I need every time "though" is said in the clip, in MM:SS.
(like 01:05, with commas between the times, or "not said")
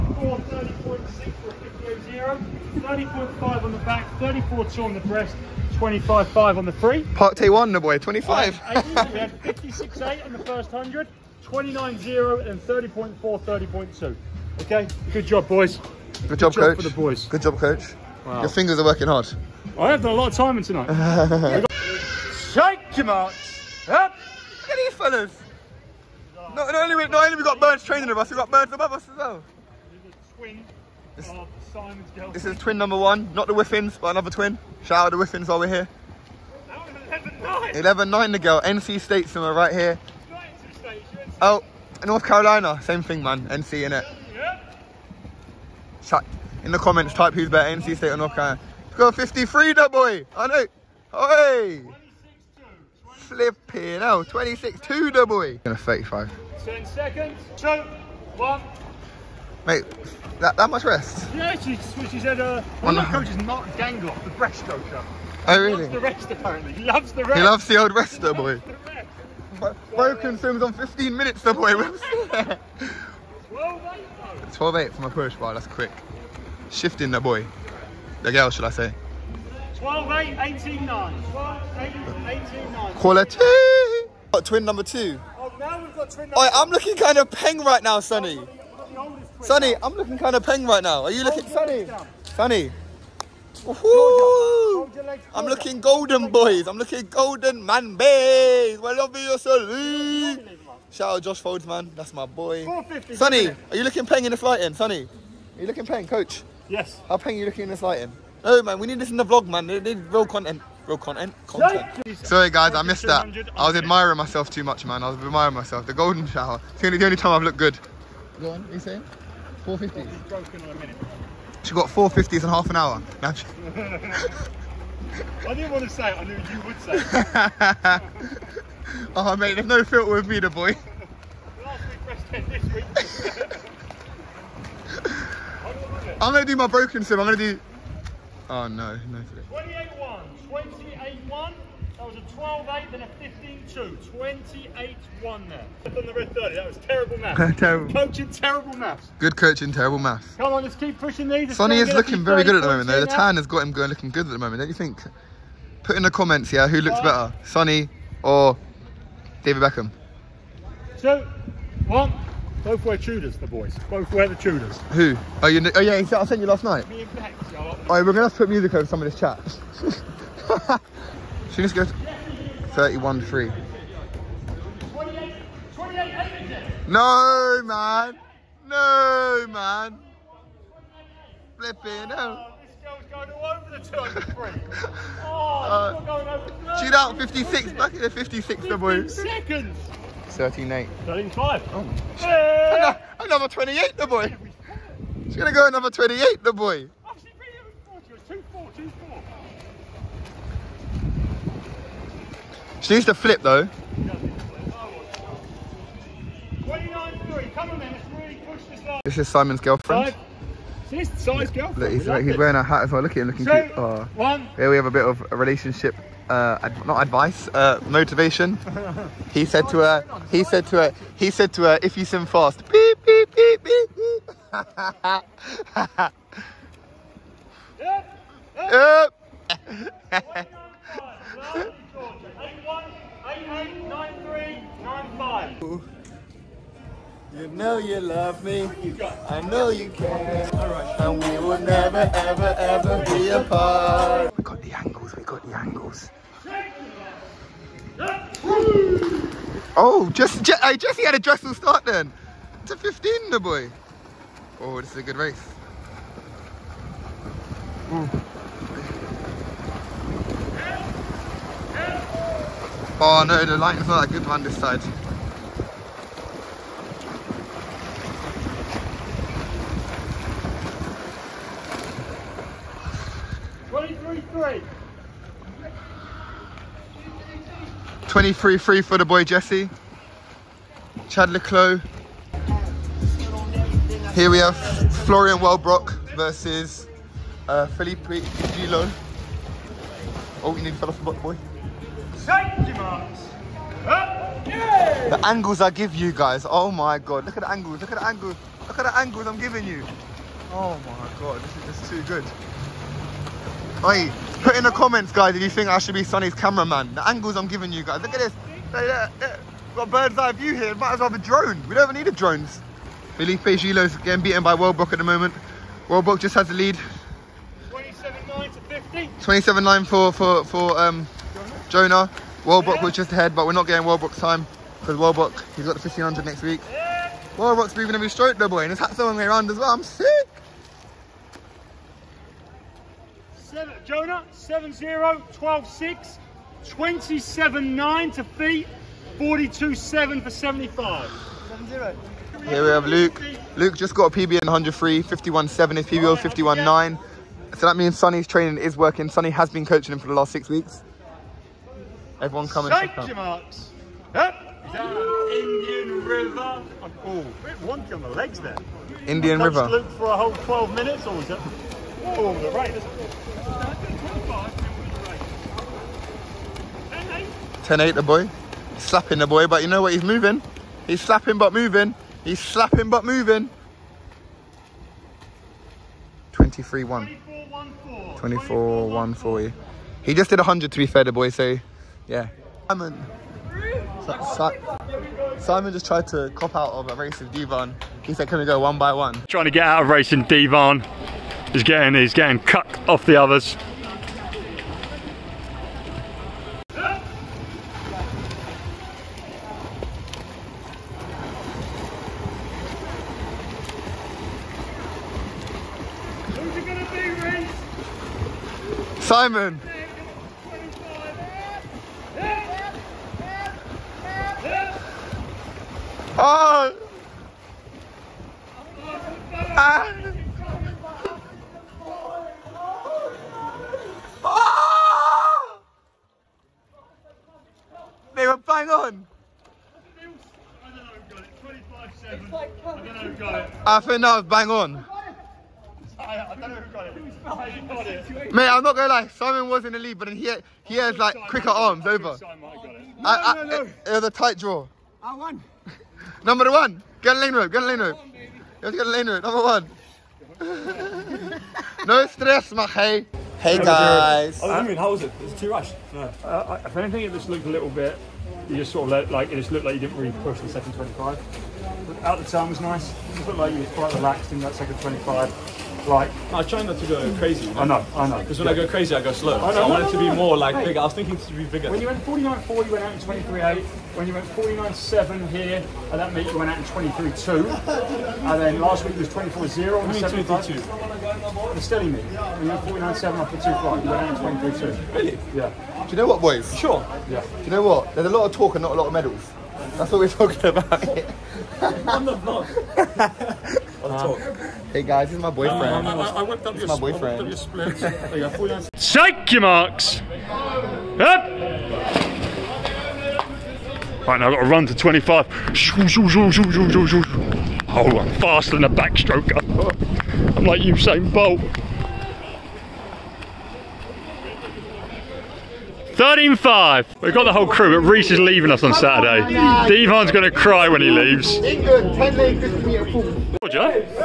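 02:32, 03:23, 05:28.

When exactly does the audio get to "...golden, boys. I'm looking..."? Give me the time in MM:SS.
01:35.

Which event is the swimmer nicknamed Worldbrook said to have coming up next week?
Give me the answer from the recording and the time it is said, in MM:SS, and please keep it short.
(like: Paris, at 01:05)
1500, at 05:25.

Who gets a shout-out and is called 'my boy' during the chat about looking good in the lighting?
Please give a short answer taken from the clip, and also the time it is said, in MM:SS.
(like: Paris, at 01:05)
Josh Folds, at 01:41.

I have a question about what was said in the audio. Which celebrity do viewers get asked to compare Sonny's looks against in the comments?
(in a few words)
David Beckham.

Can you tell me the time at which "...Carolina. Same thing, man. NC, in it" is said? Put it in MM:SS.
00:42.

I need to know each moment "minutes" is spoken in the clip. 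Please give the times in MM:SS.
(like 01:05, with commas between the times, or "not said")
01:11, 06:00.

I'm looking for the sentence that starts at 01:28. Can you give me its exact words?
Oh, Sonny, I'm looking kind of peng right now.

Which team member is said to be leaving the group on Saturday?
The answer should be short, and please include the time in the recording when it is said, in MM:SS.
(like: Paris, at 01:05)
Reese, at 08:37.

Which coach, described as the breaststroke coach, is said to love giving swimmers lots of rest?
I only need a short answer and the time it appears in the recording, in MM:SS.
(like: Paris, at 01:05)
Mark Dangoff, at 01:03.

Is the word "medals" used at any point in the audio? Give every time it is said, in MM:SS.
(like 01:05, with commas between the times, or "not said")
08:08.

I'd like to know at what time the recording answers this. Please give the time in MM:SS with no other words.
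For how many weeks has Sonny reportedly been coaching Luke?
05:50.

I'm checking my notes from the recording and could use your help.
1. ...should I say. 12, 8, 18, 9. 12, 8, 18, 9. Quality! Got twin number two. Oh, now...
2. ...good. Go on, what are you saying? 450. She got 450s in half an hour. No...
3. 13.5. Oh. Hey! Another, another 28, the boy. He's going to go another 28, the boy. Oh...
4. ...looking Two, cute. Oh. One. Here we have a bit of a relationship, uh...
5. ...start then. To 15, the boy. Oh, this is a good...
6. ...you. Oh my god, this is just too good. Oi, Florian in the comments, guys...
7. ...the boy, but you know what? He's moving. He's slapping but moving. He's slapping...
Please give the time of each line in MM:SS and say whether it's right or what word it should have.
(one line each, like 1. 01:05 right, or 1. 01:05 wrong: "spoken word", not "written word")
1. 01:18 right
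2. 01:57 right
3. 03:11 right
4. 03:33 right
5. 04:11 right
6. 04:59 wrong: "Put", not "Florian"
7. 06:09 right.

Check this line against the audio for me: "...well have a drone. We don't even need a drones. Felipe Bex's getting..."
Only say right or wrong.
wrong.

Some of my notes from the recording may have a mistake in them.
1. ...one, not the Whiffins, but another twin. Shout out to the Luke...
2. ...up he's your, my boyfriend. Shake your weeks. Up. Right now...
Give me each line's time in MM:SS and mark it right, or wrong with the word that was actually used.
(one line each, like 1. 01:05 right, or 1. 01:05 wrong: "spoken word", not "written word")
1. 00:32 wrong: "Whiffins", not "Luke"
2. 08:16 wrong: "marks", not "weeks".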